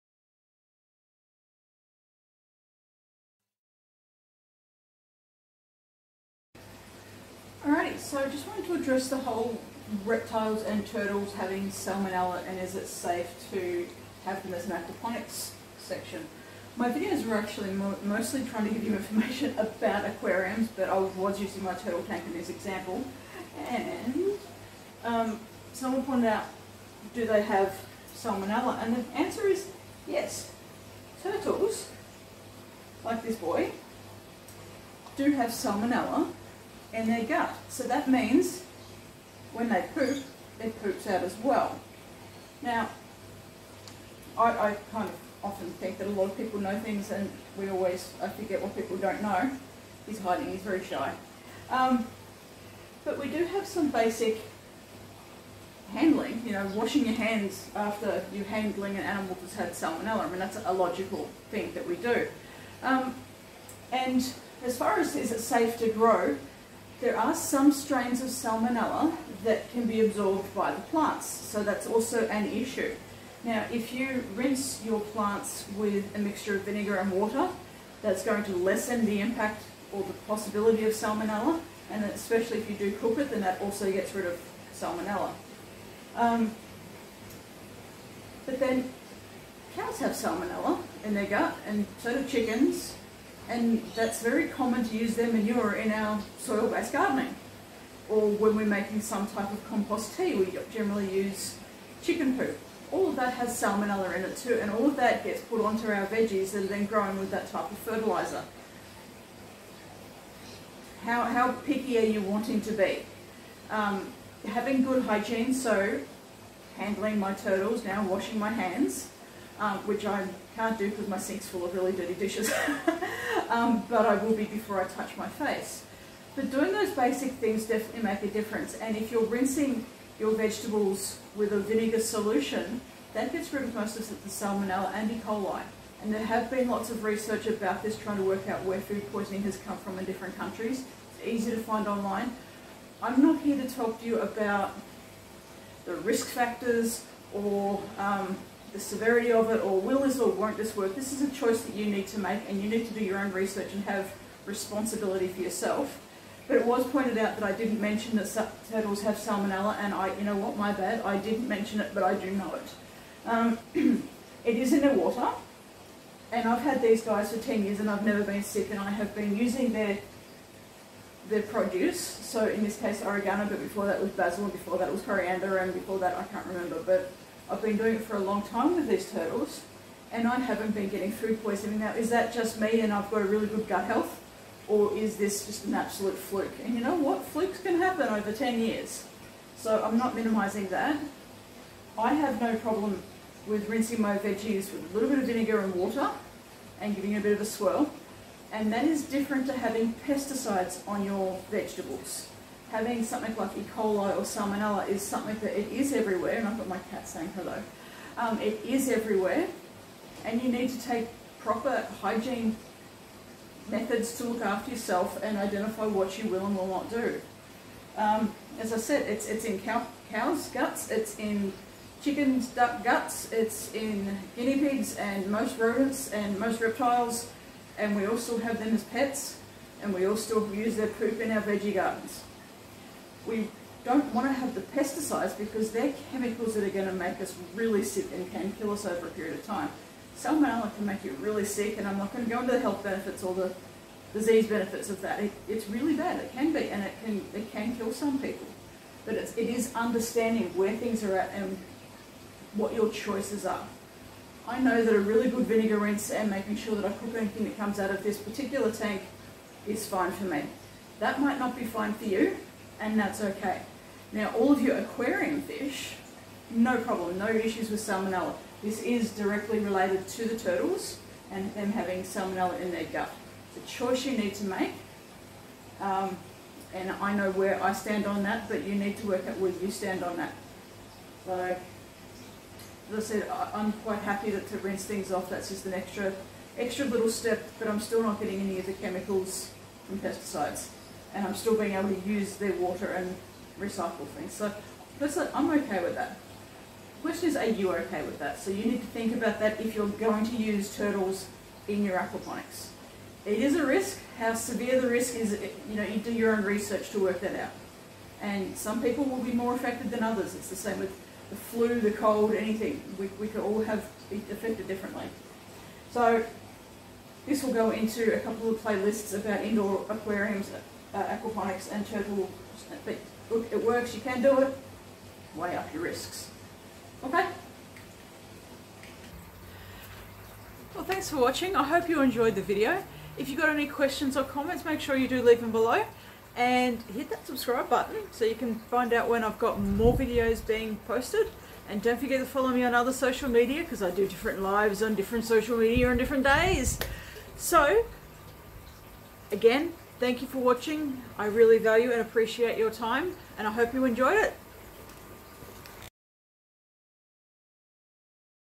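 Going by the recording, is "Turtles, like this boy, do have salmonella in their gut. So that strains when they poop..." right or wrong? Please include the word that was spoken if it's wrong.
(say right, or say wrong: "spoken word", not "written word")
wrong: "means", not "strains".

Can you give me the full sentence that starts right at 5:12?
We, we could all have be affected differently.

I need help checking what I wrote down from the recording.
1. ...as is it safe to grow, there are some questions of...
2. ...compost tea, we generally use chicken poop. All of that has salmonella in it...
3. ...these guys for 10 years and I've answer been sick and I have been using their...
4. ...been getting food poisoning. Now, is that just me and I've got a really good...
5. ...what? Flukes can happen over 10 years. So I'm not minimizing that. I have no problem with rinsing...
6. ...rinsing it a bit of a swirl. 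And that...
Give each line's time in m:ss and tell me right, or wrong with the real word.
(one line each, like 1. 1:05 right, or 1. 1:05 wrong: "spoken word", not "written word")
1. 1:04 wrong: "strains", not "questions"
2. 1:39 right
3. 2:46 wrong: "never", not "answer"
4. 3:00 right
5. 3:06 right
6. 3:16 wrong: "giving", not "rinsing".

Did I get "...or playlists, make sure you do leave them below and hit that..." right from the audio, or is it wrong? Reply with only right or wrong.
wrong.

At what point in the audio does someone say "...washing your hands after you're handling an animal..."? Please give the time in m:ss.
0:56.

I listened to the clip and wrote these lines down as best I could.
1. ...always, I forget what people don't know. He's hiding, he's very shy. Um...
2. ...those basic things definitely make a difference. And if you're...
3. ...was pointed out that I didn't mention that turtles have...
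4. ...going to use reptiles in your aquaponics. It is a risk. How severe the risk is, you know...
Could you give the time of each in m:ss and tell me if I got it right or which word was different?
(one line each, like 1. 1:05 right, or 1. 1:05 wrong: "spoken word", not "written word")
1. 0:47 right
2. 2:06 right
3. 2:36 right
4. 4:59 wrong: "turtles", not "reptiles".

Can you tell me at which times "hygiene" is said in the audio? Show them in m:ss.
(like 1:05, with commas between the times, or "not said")
1:55, 3:32.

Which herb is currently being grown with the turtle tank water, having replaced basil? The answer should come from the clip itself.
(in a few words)
Oregano.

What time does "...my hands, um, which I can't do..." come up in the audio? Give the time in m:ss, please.
1:58.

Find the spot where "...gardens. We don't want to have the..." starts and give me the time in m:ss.
3:51.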